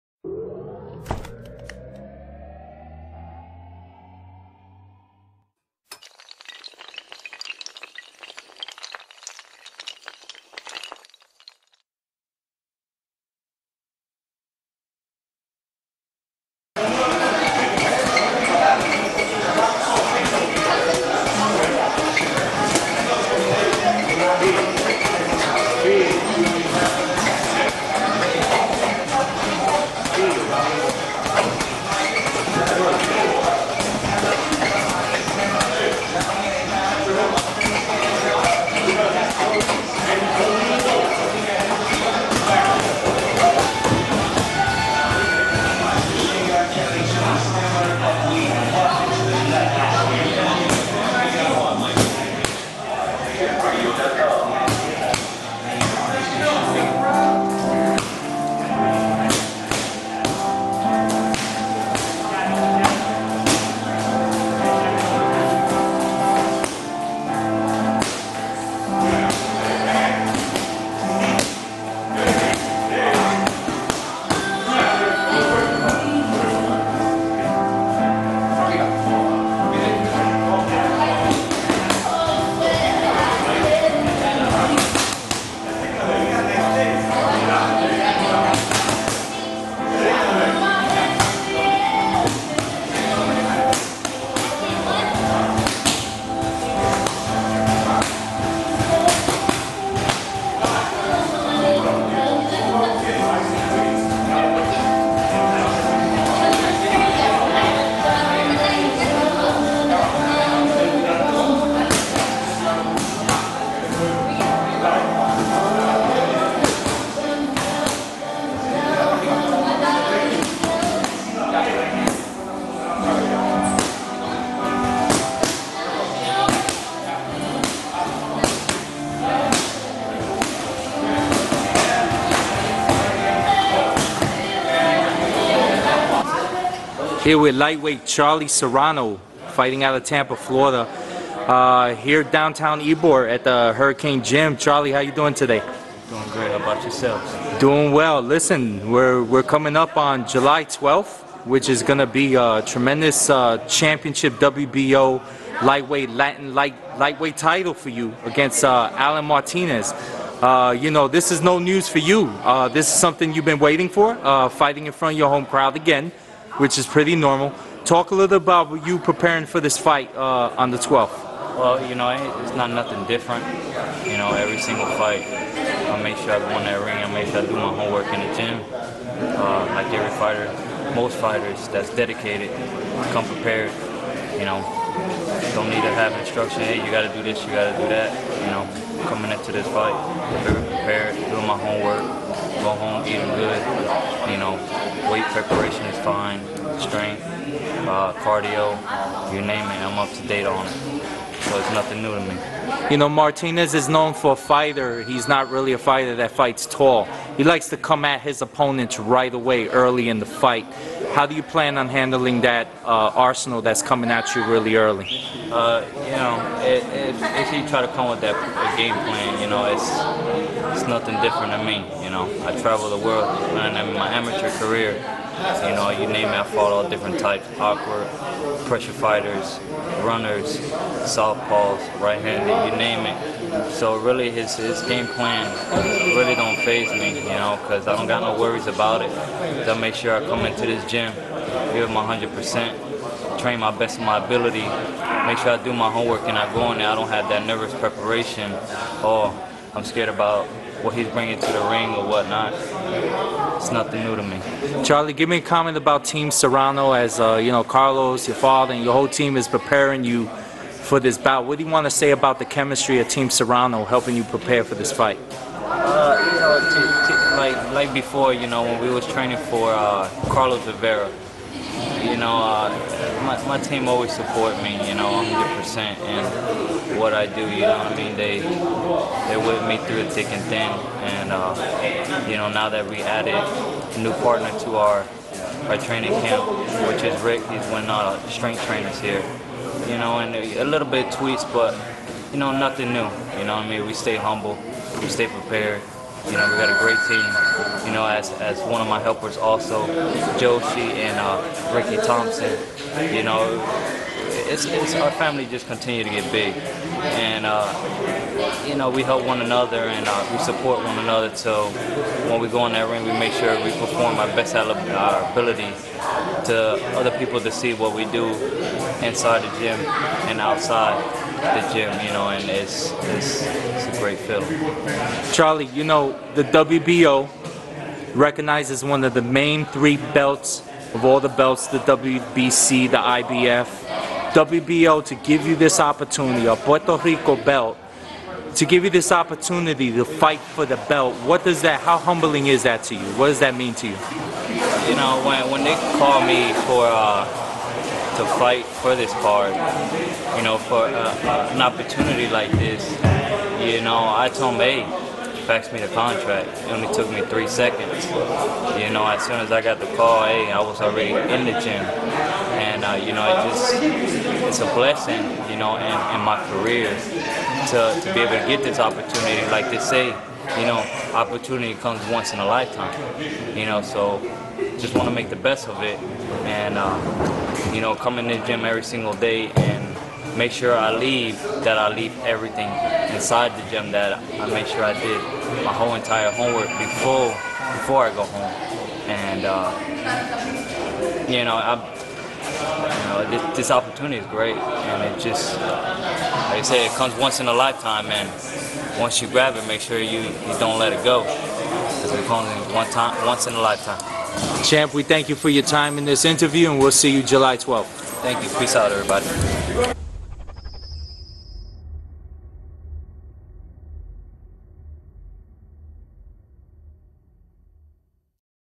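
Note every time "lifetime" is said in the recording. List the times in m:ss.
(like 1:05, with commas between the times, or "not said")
6:12, 6:37, 6:43.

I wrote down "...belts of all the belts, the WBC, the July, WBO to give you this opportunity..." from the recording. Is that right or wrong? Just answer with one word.
wrong.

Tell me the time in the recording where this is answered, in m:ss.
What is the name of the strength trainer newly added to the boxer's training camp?
4:47.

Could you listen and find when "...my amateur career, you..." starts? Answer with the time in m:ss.
3:43.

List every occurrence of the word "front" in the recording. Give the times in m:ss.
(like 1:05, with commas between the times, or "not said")
2:44.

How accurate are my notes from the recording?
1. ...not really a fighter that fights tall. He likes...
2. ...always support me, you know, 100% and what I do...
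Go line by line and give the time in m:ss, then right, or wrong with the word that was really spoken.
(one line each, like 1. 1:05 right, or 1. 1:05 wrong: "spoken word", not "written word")
1. 3:25 right
2. 4:33 right.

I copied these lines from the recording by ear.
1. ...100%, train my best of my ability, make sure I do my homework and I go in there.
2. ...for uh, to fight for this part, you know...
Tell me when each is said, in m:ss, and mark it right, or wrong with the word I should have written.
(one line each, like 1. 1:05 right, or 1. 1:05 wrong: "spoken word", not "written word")
1. 4:02 right
2. 5:46 right.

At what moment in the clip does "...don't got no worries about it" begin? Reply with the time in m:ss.
3:57.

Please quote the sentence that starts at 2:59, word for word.
Uh, like every fighter, most fighters that's dedicated, come prepared.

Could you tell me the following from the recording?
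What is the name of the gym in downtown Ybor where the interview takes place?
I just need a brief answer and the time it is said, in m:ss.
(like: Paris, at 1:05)
Hurricane Gym, at 2:23.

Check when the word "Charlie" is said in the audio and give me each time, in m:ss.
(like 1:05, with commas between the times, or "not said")
2:18, 2:24, 4:14, 5:25.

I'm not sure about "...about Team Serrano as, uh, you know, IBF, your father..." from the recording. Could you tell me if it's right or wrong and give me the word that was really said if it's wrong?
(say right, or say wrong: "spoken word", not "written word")
wrong: "Carlos", not "IBF".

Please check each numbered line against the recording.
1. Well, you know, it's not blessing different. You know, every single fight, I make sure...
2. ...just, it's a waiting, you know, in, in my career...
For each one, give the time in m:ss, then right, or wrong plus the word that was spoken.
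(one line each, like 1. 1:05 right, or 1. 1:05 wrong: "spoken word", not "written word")
1. 2:51 wrong: "nothing", not "blessing"
2. 6:03 wrong: "blessing", not "waiting".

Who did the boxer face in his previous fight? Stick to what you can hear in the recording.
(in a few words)
Carlos Rivera.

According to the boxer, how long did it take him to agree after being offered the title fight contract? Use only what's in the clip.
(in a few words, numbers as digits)
3 seconds.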